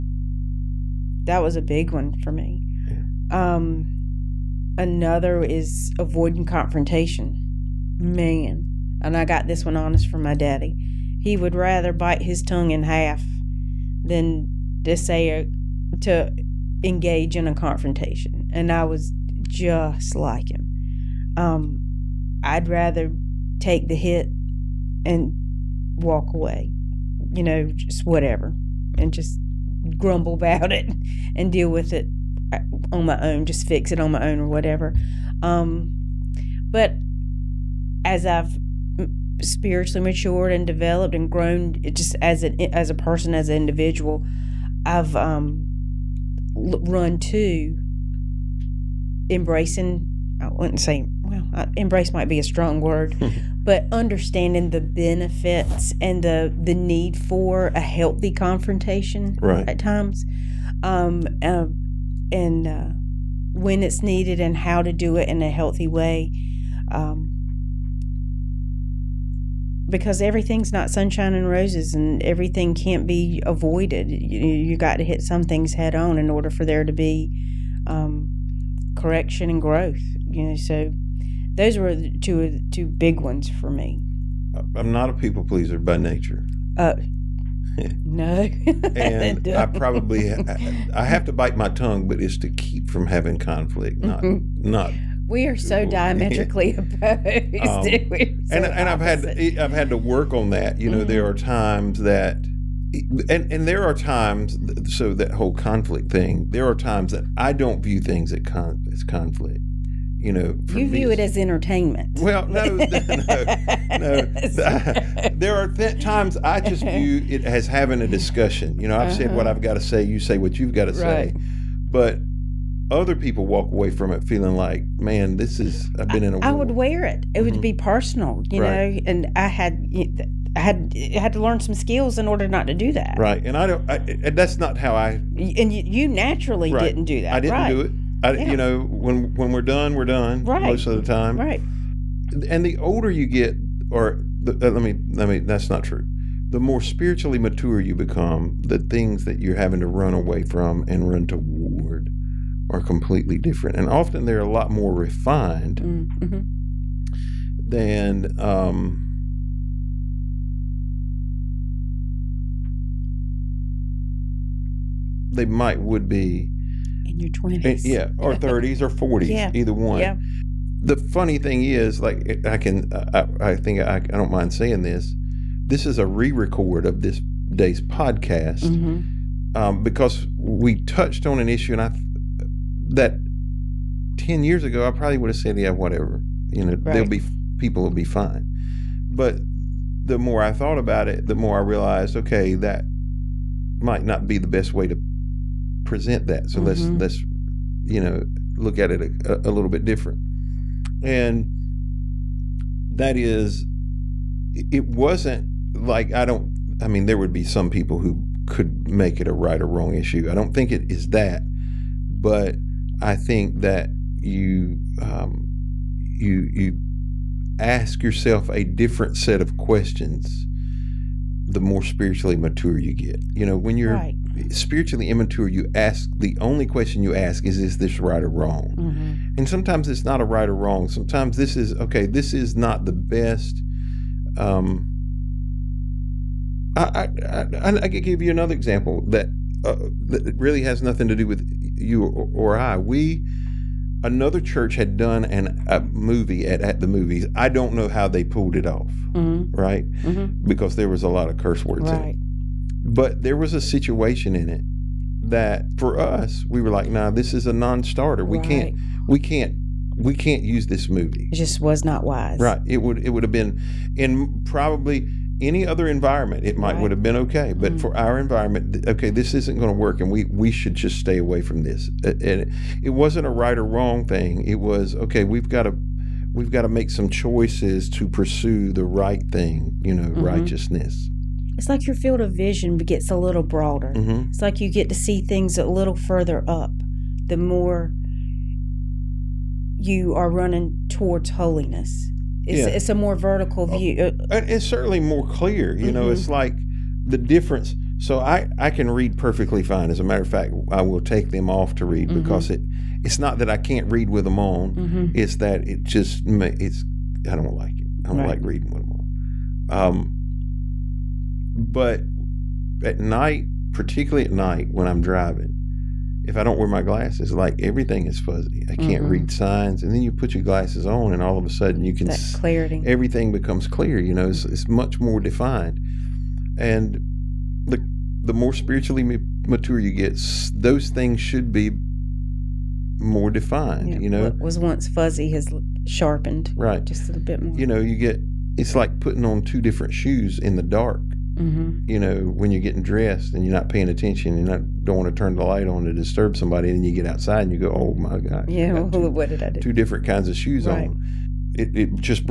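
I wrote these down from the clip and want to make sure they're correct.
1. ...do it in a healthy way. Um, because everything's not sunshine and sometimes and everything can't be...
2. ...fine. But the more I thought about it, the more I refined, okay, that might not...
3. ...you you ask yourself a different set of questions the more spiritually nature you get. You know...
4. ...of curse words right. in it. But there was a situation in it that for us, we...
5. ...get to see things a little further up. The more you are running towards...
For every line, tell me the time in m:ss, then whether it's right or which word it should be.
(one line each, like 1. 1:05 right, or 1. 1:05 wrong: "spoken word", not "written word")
1. 1:04 wrong: "roses", not "sometimes"
2. 3:08 wrong: "realized", not "refined"
3. 3:35 wrong: "mature", not "nature"
4. 4:11 right
5. 4:44 right.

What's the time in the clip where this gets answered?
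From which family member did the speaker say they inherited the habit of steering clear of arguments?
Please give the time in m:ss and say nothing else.
0:10.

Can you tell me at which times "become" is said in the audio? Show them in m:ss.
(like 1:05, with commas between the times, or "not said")
2:27, 5:23.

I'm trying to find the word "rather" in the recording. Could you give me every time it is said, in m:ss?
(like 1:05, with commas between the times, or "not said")
0:11, 0:22.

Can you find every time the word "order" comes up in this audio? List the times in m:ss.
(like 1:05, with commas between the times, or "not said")
1:16, 2:12.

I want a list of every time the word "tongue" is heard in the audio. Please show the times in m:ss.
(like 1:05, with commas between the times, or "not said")
0:12, 1:31.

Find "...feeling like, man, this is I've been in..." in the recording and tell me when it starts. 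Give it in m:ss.
2:04.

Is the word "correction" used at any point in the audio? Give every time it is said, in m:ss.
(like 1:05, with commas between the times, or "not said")
1:18.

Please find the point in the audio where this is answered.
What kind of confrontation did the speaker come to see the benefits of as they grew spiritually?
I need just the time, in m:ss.
0:57.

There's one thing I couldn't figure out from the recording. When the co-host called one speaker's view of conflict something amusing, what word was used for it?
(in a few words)
entertainment.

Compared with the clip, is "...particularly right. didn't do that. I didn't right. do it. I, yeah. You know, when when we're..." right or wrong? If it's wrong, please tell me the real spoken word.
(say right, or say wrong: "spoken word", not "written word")
wrong: "naturally", not "particularly".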